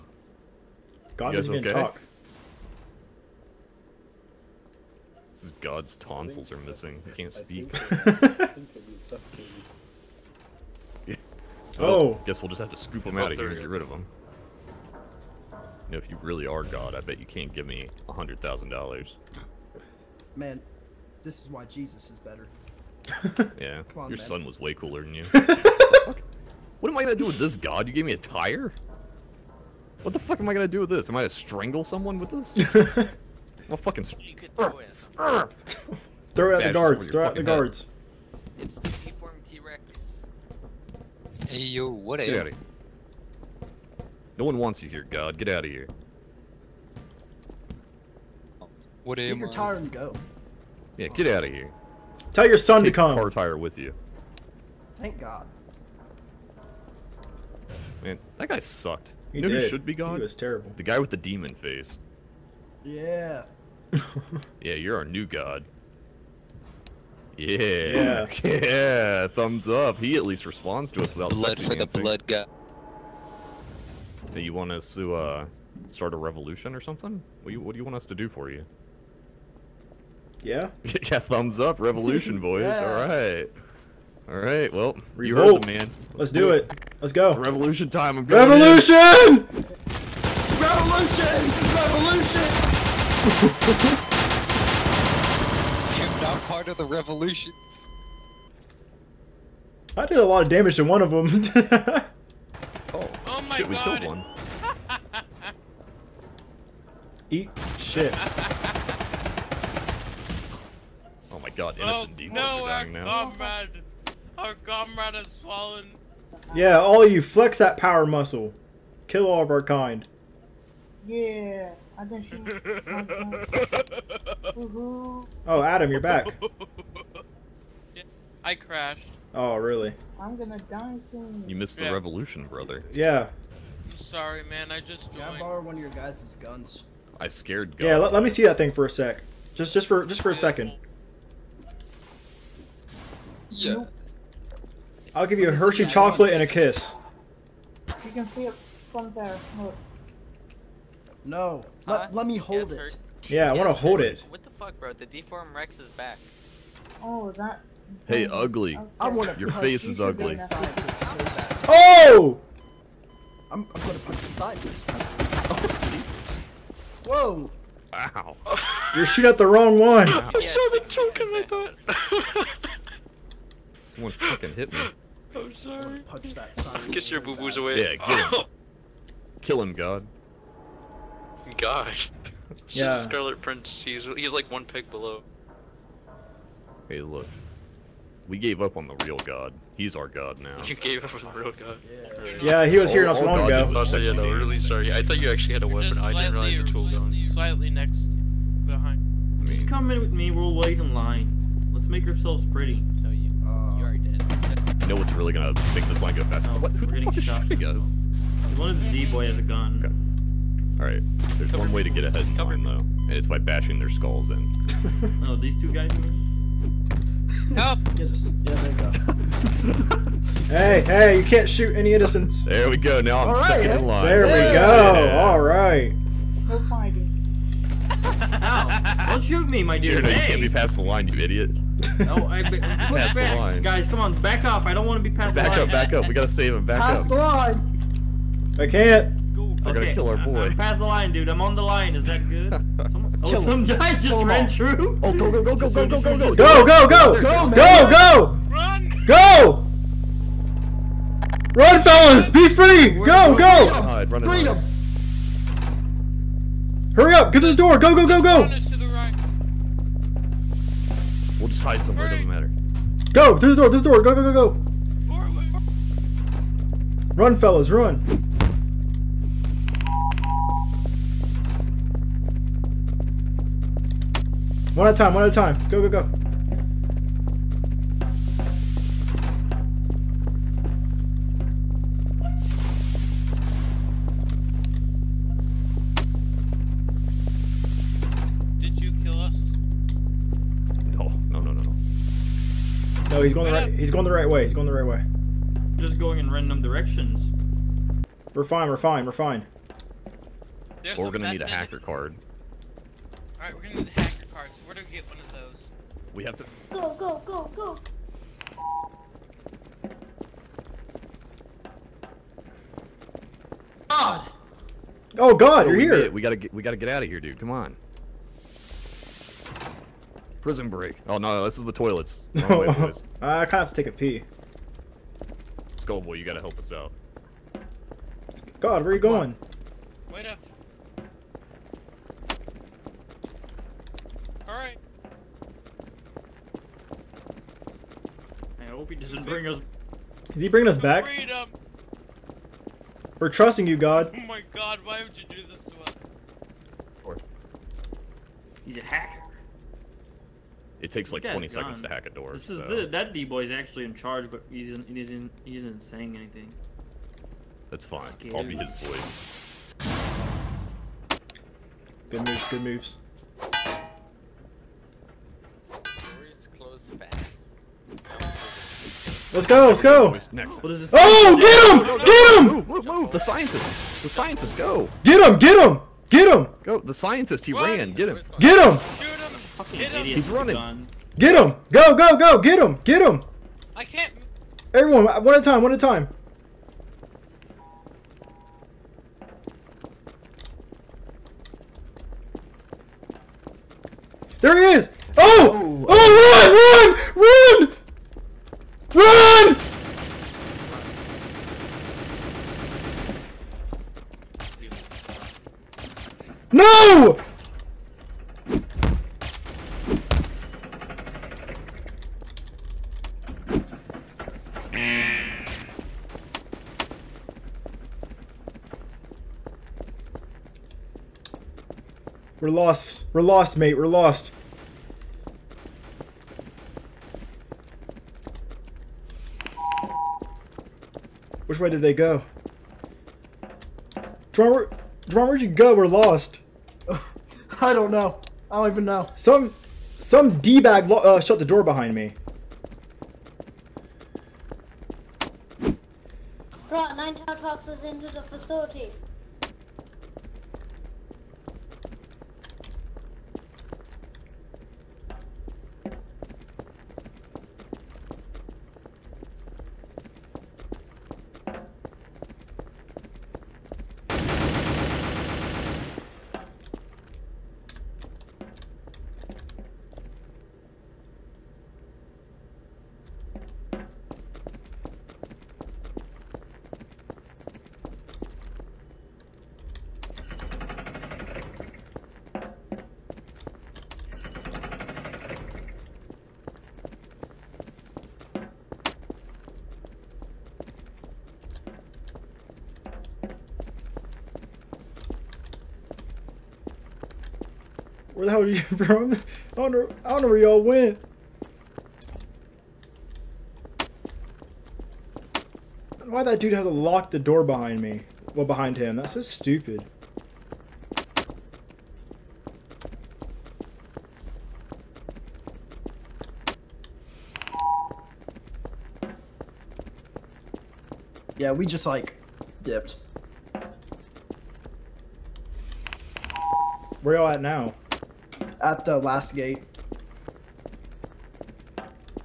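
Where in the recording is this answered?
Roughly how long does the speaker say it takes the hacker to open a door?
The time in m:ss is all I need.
5:51.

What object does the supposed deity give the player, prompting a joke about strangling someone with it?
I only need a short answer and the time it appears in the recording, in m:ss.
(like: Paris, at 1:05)
A tire, at 0:27.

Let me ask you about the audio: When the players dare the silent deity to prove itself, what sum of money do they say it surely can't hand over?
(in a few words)
$100,000.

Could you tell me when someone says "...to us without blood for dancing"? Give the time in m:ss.
1:10.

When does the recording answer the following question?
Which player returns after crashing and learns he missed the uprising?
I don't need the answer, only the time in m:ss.
2:04.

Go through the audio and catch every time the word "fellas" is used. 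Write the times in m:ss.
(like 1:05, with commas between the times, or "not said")
4:11, 4:27.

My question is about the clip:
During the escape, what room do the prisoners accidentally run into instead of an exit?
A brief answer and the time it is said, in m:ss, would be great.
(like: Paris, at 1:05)
The toilets, at 5:21.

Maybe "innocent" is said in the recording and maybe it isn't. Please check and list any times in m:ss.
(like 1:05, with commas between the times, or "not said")
1:52, 3:41.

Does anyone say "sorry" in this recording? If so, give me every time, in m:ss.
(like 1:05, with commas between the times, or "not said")
2:13, 2:55, 3:14.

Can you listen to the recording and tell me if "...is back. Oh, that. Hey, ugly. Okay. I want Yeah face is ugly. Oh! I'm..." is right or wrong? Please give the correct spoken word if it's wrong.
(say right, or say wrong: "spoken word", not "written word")
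wrong: "Your", not "Yeah".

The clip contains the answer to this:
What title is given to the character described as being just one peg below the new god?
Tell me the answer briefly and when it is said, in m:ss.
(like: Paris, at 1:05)
Scarlet Prince, at 3:02.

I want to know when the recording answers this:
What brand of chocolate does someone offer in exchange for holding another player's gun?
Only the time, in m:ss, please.
2:25.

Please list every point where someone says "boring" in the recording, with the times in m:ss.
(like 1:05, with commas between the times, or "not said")
not said.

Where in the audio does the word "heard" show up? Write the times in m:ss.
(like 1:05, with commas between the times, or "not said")
1:25.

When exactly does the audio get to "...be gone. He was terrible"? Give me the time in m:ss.
0:59.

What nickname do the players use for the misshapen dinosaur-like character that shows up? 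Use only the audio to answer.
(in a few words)
Deformed T-Rex.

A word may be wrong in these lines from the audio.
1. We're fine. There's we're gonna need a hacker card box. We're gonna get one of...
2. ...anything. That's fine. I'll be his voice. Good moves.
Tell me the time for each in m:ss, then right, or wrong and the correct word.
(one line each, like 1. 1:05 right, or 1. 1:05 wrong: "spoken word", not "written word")
1. 4:59 right
2. 5:56 right.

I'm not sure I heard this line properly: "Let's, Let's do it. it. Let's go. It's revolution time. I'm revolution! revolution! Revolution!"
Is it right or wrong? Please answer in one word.
right.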